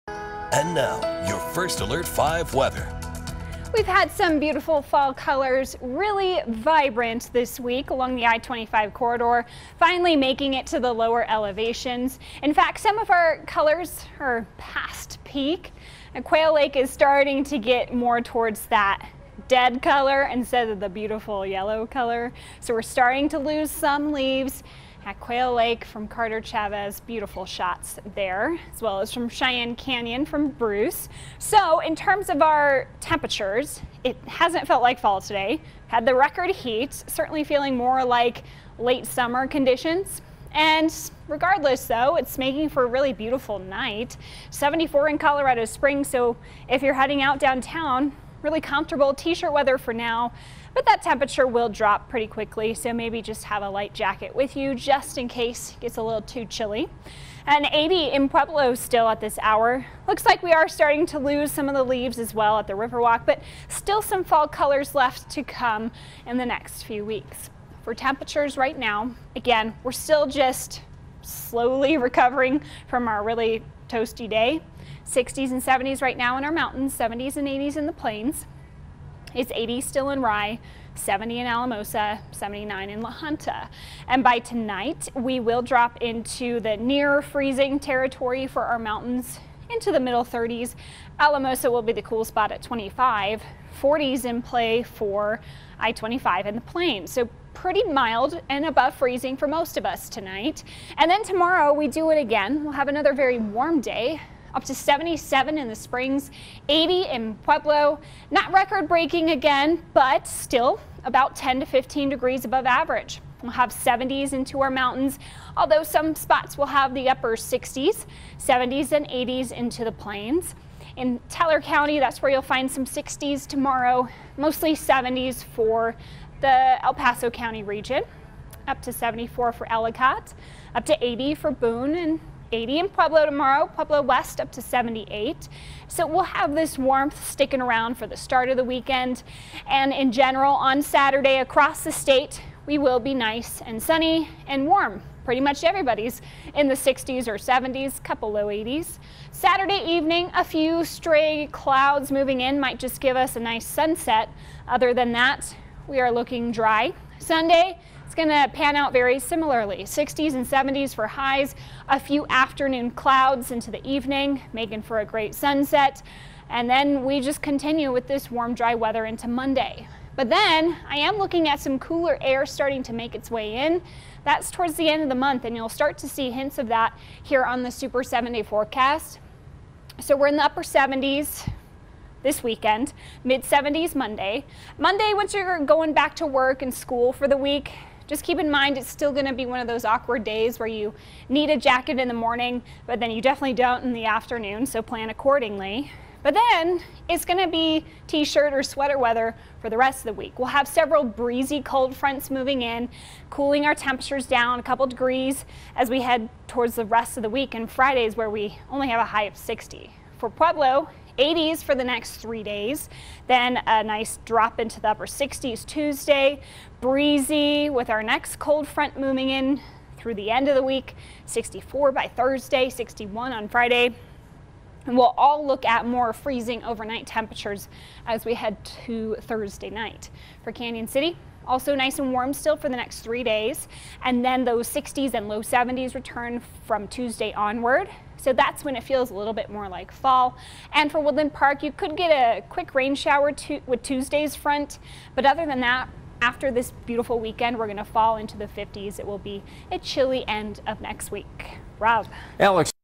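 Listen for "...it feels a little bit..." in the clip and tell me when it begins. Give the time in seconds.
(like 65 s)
238 s.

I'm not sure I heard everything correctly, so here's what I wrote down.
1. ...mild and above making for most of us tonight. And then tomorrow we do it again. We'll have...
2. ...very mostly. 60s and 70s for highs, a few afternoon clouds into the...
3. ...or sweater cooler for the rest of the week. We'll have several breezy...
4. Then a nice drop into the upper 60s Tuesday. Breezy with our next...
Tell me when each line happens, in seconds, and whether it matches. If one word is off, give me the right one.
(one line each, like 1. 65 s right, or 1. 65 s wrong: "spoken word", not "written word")
1. 97 s wrong: "freezing", not "making"
2. 158 s wrong: "similarly", not "mostly"
3. 198 s wrong: "weather", not "cooler"
4. 213 s right.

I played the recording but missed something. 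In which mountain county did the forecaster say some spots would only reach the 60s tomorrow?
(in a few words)
Teller County.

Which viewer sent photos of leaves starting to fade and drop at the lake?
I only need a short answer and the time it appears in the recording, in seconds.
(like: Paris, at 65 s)
Carter Chavez, at 26 s.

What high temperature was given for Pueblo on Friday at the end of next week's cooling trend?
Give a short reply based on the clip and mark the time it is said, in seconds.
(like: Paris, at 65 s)
61, at 222 s.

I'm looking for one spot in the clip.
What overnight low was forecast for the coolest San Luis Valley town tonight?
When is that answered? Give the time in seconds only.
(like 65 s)
92 s.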